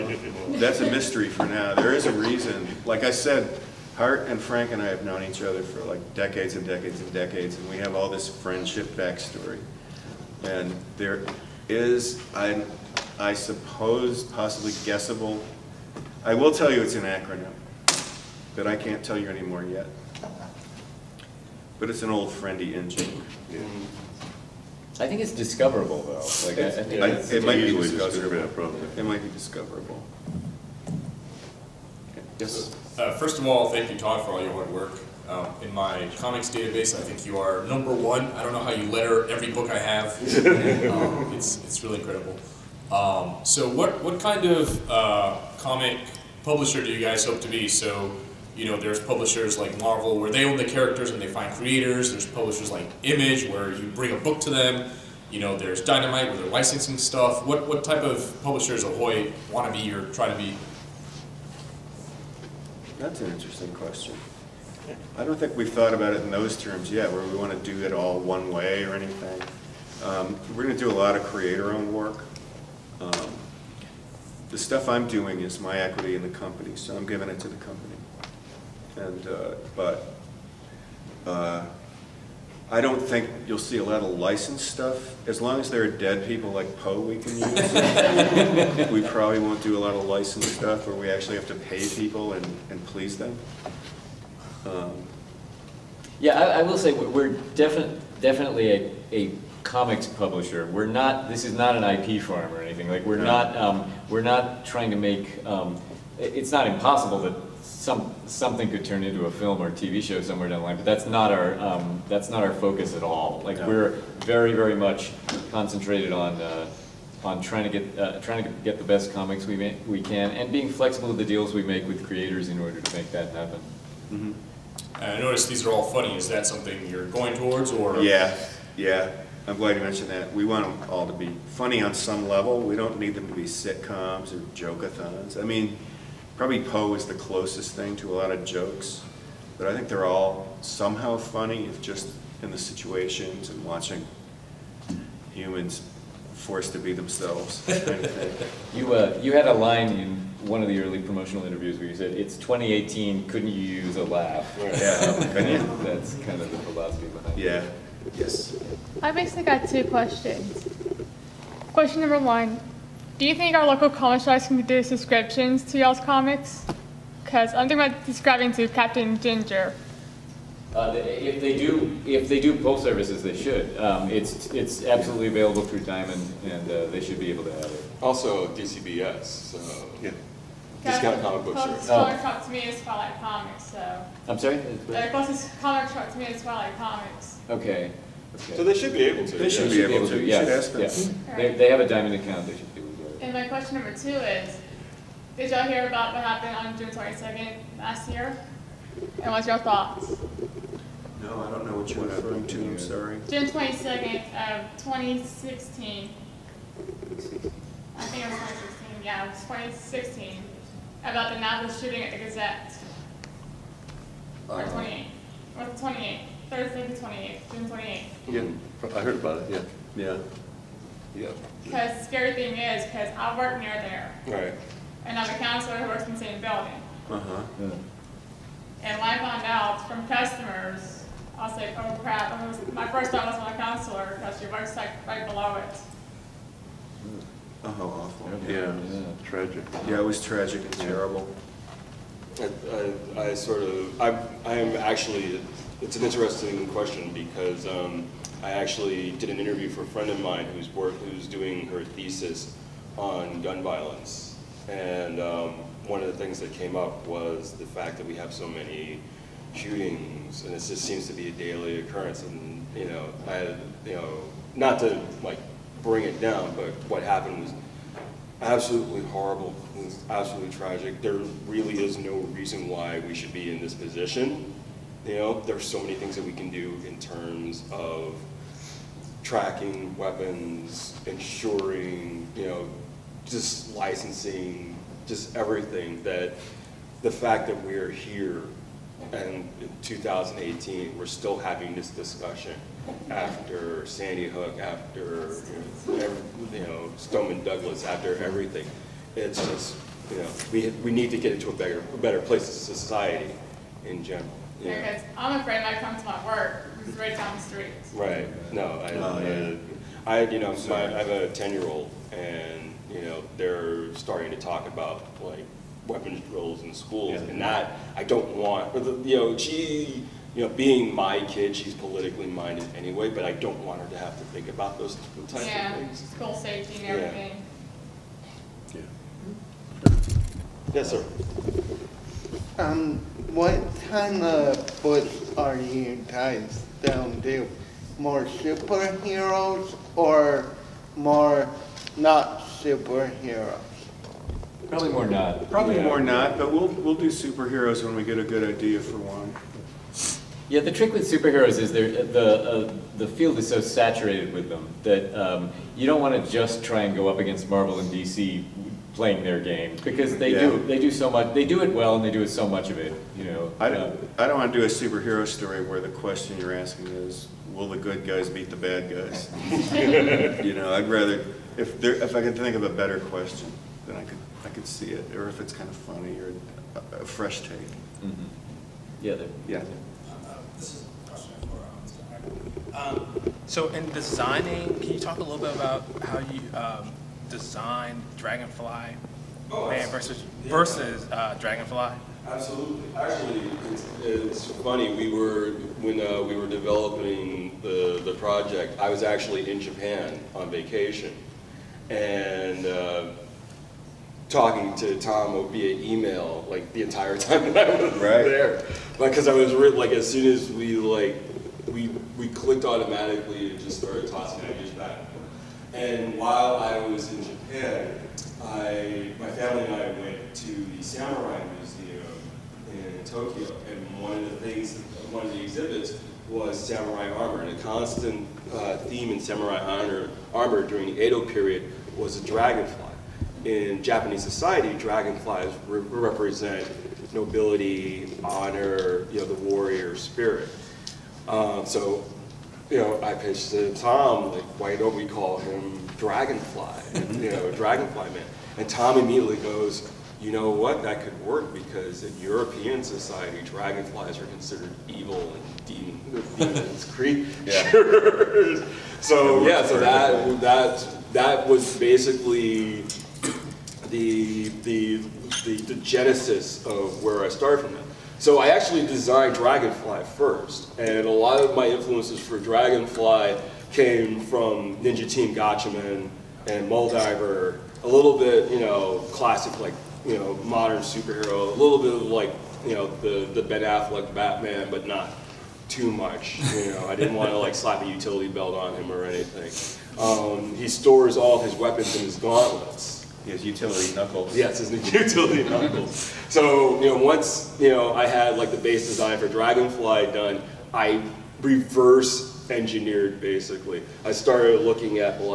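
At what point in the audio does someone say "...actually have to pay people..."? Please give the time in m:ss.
1:31.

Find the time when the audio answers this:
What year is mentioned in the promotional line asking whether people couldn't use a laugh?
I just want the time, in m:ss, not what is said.
2:32.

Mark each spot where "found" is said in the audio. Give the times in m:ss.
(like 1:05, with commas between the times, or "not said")
3:49.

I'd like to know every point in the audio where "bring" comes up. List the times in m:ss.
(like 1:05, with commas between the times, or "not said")
0:53, 4:25.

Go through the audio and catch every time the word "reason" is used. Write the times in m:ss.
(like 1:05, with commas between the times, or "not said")
0:02, 4:32.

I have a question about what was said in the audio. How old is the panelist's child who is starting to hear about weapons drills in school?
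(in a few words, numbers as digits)
10.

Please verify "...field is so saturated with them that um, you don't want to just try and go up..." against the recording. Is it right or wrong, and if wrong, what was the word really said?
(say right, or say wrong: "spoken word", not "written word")
right.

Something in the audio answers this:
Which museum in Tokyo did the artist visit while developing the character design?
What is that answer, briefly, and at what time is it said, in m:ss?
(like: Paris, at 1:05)
Samurai Museum, at 7:00.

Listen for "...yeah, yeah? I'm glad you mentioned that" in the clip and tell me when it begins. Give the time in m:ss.
2:08.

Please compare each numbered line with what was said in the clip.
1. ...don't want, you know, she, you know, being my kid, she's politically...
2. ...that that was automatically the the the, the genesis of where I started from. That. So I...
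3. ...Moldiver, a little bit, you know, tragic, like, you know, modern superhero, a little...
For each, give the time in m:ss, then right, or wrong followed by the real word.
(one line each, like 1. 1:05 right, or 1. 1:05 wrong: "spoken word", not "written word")
1. 5:18 right
2. 7:40 wrong: "basically", not "automatically"
3. 7:56 wrong: "classic", not "tragic".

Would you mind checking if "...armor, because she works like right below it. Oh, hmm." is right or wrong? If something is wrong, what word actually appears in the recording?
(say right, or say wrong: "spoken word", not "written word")
wrong: "counselor", not "armor".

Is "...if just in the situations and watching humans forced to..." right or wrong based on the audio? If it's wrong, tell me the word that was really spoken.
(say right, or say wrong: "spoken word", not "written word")
right.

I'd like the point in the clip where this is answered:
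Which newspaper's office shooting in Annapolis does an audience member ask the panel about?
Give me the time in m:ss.
3:32.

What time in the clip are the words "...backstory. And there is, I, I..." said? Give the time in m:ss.
0:08.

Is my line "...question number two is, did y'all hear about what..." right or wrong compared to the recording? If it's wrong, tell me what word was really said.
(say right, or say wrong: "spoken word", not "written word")
right.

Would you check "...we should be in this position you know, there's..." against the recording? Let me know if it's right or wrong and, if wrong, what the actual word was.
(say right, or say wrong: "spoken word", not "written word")
right.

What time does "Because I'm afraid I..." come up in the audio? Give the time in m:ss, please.
5:04.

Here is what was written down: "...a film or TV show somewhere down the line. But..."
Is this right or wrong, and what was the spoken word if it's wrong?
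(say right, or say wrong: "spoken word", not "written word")
right.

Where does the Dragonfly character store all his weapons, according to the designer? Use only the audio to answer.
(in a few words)
his gauntlets.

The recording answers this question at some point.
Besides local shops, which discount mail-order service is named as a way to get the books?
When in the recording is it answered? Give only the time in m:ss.
2:58.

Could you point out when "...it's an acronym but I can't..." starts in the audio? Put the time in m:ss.
0:16.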